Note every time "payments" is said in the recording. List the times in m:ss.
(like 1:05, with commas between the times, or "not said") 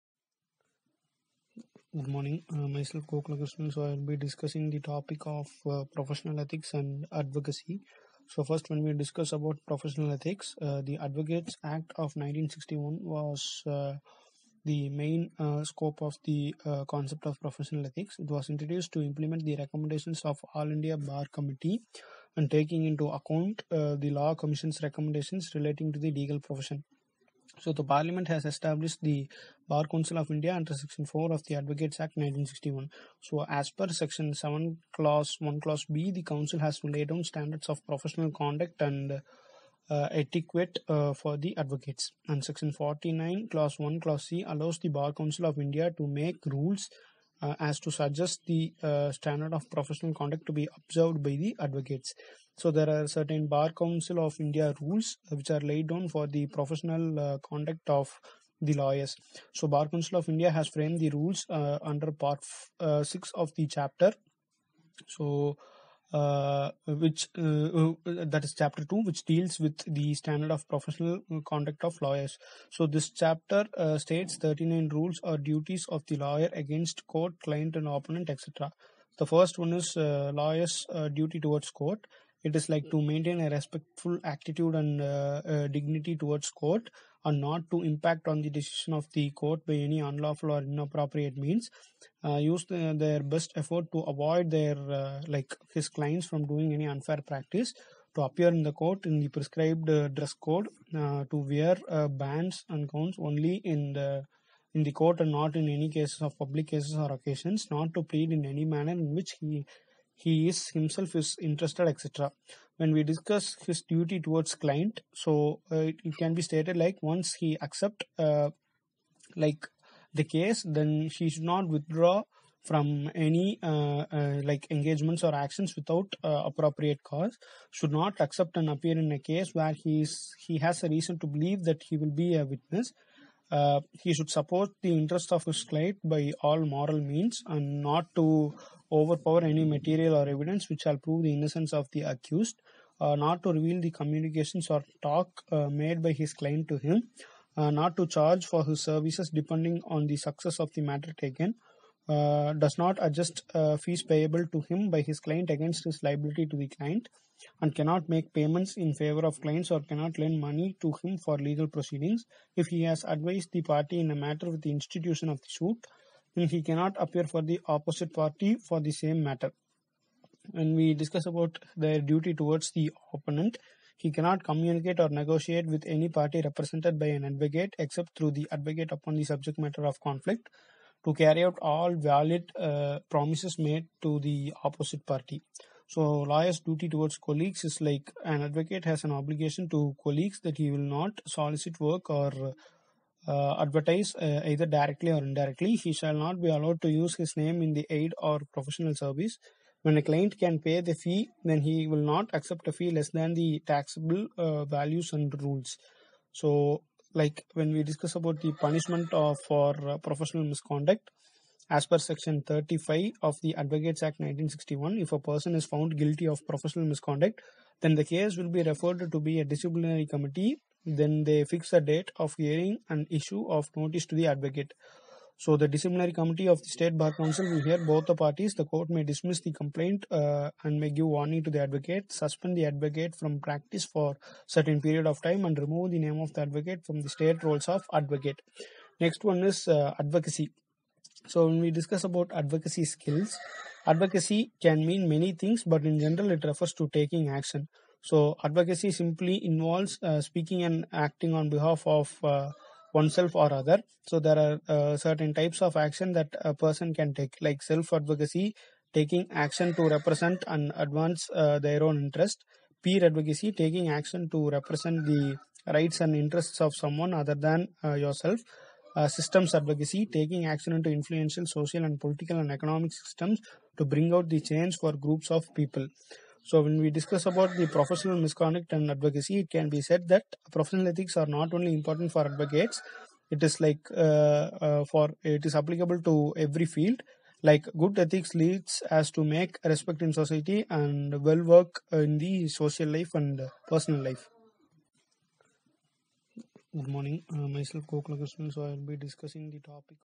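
2:38.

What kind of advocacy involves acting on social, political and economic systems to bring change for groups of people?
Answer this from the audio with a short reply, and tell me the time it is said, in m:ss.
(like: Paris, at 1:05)
Systems advocacy, at 4:29.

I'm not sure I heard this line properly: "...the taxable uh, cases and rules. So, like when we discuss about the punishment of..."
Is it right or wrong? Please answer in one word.
wrong.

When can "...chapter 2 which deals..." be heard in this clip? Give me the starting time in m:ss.
1:08.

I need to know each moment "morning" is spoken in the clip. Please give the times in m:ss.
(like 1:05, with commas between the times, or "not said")
0:02, 4:56.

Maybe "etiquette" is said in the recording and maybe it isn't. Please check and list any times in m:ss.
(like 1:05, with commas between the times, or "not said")
0:40.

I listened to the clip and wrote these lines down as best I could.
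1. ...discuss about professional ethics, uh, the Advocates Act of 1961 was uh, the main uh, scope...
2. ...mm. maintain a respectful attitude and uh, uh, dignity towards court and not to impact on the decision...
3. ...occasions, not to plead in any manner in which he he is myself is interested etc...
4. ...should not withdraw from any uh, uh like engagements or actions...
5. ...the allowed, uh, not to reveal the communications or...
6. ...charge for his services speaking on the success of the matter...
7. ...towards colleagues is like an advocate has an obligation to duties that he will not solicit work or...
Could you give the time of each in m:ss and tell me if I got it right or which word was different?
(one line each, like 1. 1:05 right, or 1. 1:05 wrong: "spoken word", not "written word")
1. 0:08 right
2. 1:22 right
3. 1:47 wrong: "himself", not "myself"
4. 2:01 right
5. 2:21 wrong: "accused", not "allowed"
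6. 2:28 wrong: "depending", not "speaking"
7. 3:06 wrong: "colleagues", not "duties".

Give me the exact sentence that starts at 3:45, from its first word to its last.
So the disciplinary committee of the state bar council will hear both the parties.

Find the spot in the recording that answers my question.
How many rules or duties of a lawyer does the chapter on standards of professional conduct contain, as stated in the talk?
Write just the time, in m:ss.
1:14.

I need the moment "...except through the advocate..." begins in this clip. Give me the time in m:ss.
2:57.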